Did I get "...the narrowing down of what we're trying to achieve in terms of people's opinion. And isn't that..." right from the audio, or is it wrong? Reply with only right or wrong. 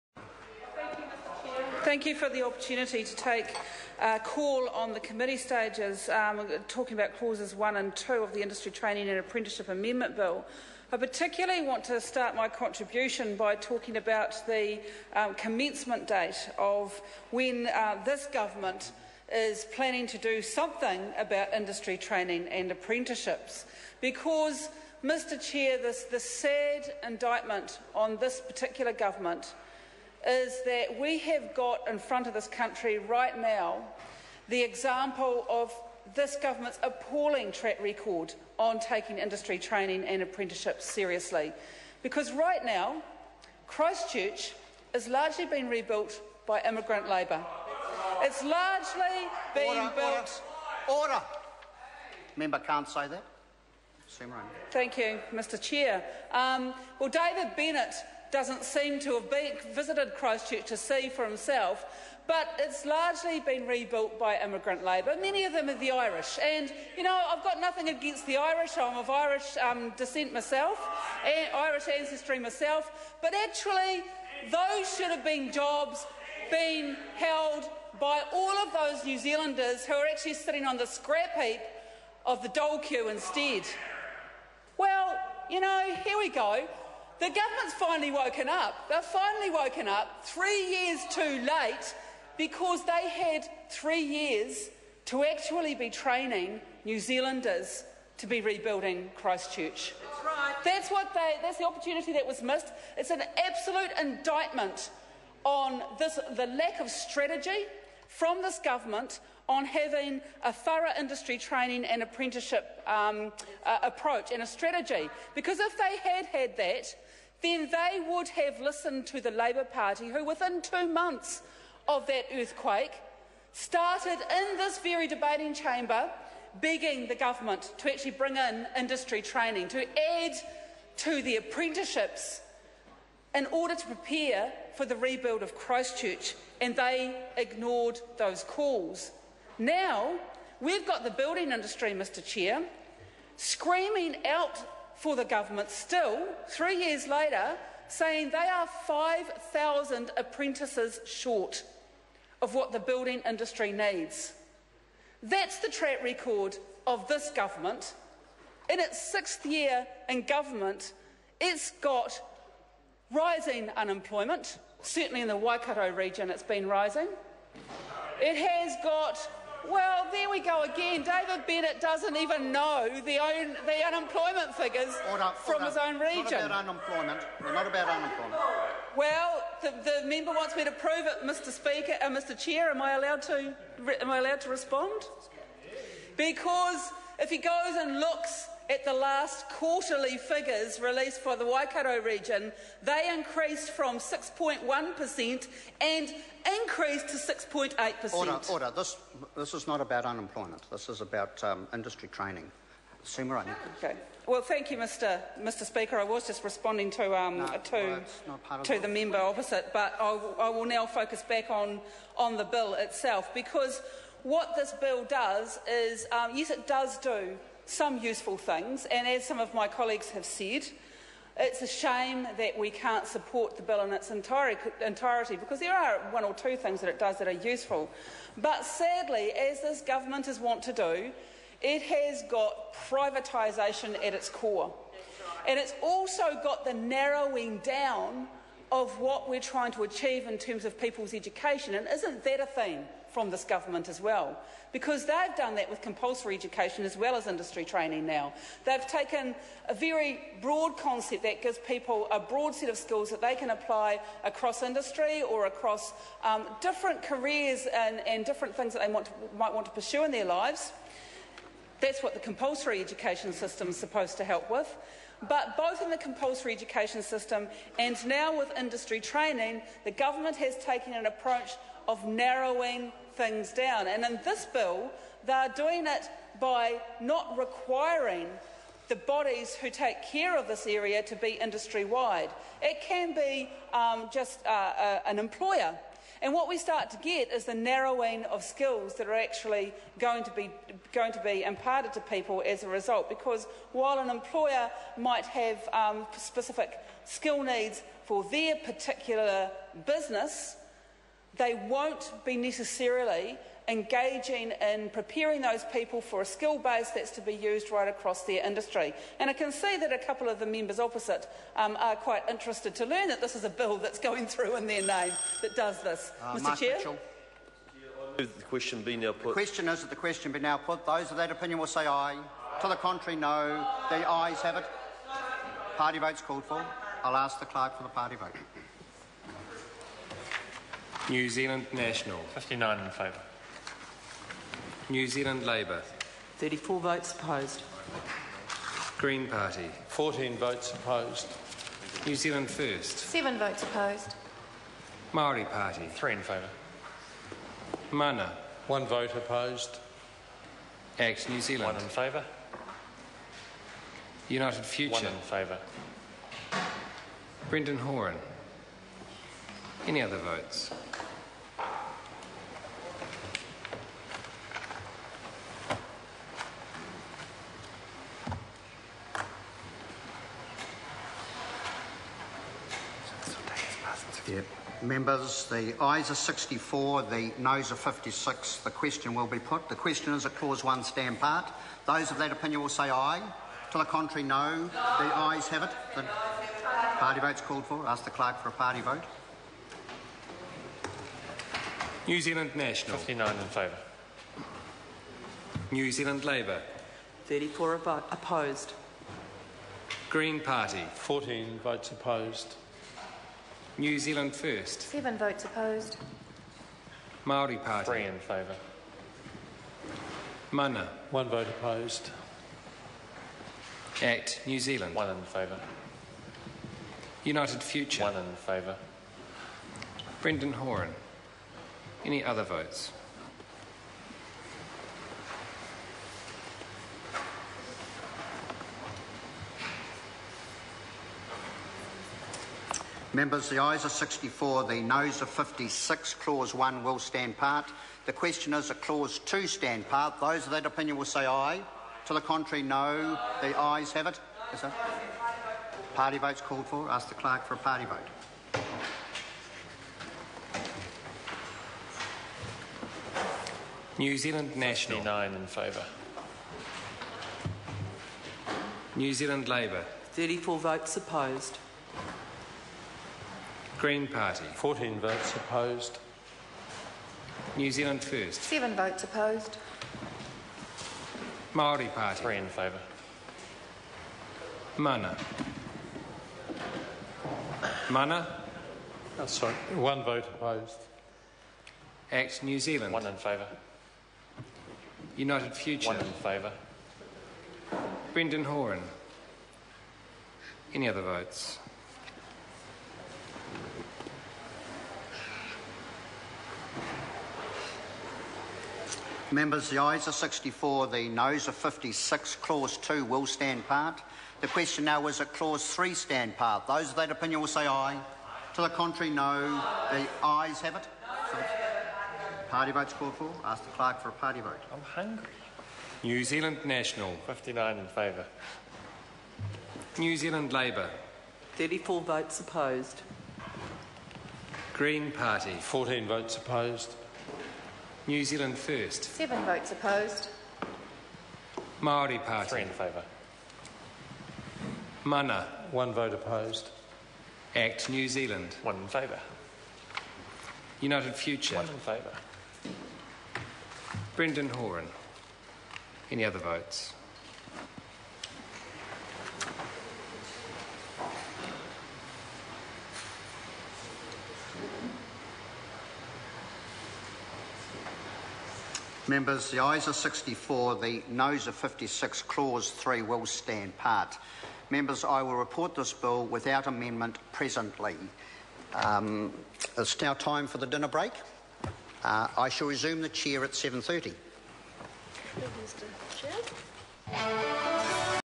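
wrong.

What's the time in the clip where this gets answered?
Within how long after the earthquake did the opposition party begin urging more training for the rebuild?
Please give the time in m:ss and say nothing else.
2:00.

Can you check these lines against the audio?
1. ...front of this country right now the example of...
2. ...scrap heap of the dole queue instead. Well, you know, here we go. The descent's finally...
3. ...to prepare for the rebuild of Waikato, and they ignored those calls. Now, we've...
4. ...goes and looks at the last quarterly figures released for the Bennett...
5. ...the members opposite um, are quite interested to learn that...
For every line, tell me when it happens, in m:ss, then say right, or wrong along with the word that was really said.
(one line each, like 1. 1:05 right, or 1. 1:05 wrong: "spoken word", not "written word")
1. 0:31 right
2. 1:20 wrong: "government", not "descent"
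3. 2:13 wrong: "Christchurch", not "Waikato"
4. 3:07 wrong: "Waikato", not "Bennett"
5. 5:10 right.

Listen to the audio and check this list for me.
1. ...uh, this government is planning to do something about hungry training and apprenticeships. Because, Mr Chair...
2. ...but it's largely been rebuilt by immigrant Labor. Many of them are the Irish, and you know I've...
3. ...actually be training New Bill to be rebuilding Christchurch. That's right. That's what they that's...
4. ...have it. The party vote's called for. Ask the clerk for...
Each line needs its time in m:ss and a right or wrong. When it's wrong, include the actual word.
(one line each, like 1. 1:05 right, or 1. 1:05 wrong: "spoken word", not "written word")
1. 0:17 wrong: "industry", not "hungry"
2. 1:02 right
3. 1:35 wrong: "Zealanders", not "Bill"
4. 6:25 right.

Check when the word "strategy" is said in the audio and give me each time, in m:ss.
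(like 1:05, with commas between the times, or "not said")
1:46, 1:54.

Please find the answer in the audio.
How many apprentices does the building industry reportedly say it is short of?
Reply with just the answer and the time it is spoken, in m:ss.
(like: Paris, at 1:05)
5,000, at 2:28.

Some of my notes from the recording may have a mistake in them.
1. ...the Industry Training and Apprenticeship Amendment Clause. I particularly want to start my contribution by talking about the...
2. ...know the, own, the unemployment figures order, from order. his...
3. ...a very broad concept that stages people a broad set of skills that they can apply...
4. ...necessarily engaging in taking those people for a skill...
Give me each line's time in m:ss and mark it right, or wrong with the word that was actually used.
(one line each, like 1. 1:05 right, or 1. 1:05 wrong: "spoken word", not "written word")
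1. 0:08 wrong: "Bill", not "Clause"
2. 2:52 right
3. 4:09 wrong: "gives", not "stages"
4. 5:02 wrong: "preparing", not "taking".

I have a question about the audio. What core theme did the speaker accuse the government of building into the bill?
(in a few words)
privatisation.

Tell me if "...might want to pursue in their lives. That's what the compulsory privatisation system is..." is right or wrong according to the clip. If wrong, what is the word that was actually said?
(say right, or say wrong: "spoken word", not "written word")
wrong: "education", not "privatisation".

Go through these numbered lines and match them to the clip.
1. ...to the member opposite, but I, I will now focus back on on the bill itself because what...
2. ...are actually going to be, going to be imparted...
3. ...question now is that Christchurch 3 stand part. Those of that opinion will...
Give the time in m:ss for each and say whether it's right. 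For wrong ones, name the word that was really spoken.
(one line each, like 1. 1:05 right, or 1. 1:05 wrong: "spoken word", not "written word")
1. 3:28 right
2. 4:49 right
3. 8:24 wrong: "Clause", not "Christchurch".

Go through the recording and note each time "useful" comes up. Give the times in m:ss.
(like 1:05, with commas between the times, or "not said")
3:38, 3:47.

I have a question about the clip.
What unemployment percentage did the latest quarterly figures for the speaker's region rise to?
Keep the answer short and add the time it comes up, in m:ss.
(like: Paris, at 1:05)
6.8%, at 3:17.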